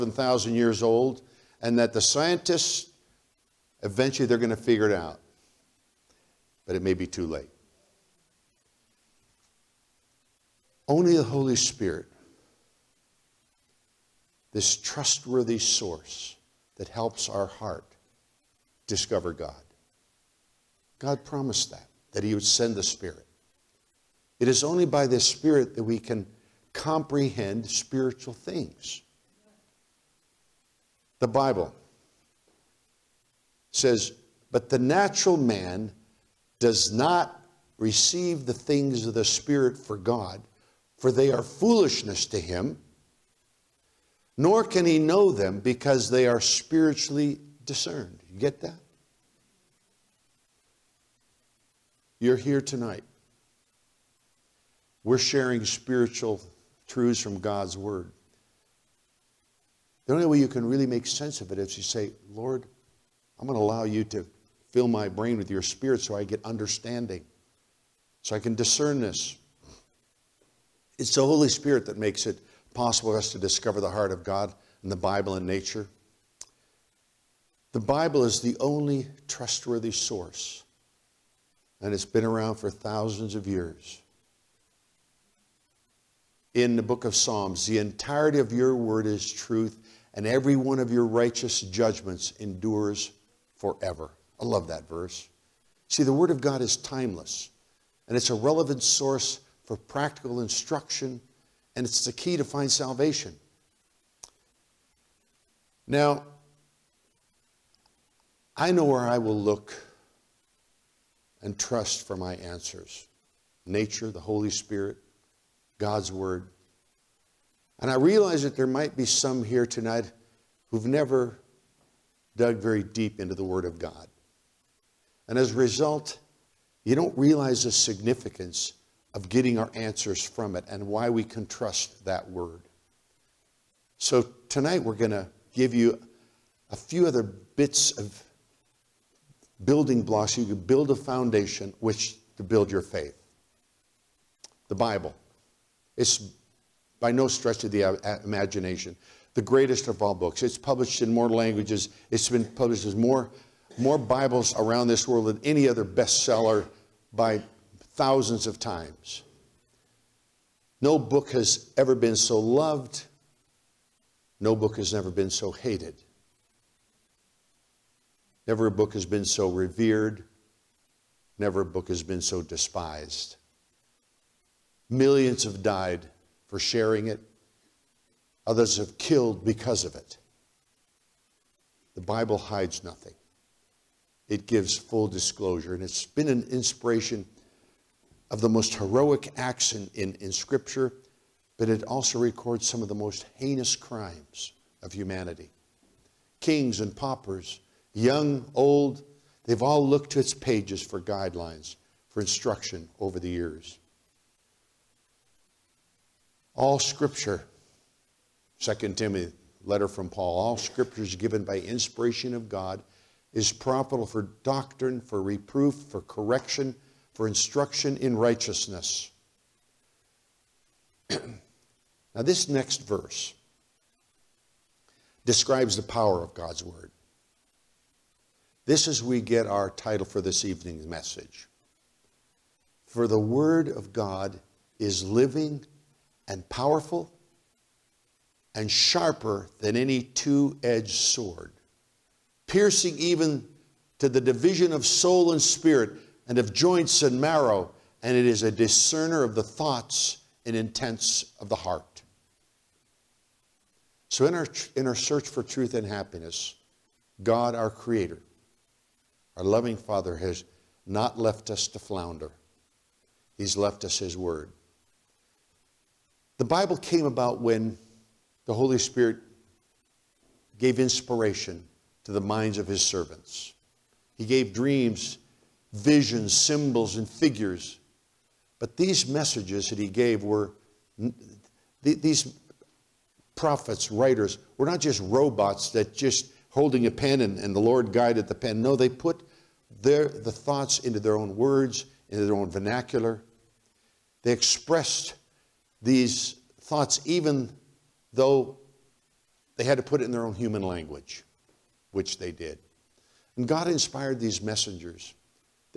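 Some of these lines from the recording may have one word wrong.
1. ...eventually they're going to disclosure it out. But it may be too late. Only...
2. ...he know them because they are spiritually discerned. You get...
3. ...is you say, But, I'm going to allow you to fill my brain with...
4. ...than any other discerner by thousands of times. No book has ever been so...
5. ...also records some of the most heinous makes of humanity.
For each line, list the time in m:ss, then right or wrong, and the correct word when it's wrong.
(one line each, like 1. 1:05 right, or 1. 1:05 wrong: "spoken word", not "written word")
1. 0:03 wrong: "figure", not "disclosure"
2. 0:44 right
3. 1:01 wrong: "Lord", not "But"
4. 2:35 wrong: "bestseller", not "discerner"
5. 3:11 wrong: "crimes", not "makes".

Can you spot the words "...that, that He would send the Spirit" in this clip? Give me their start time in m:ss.
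0:21.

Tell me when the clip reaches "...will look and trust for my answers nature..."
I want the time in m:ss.
1:49.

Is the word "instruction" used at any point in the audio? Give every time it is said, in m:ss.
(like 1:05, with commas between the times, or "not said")
1:40, 3:22, 3:37.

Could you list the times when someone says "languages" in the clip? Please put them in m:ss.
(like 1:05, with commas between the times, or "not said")
2:31, 5:00.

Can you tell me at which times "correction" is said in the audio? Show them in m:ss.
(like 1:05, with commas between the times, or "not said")
3:36.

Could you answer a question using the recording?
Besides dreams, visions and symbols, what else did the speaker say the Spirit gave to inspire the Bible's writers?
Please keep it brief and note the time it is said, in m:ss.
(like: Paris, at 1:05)
Figures, at 4:37.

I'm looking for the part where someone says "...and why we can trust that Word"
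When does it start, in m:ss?
2:10.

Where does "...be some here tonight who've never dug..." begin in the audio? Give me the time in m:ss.
1:58.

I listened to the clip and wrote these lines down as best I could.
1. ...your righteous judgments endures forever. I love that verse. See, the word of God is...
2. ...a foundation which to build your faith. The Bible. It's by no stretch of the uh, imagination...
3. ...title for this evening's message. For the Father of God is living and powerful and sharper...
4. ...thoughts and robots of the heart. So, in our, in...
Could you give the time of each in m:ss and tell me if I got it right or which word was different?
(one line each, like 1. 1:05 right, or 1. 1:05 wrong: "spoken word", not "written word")
1. 1:30 right
2. 2:20 right
3. 3:49 wrong: "Word", not "Father"
4. 4:09 wrong: "intents", not "robots".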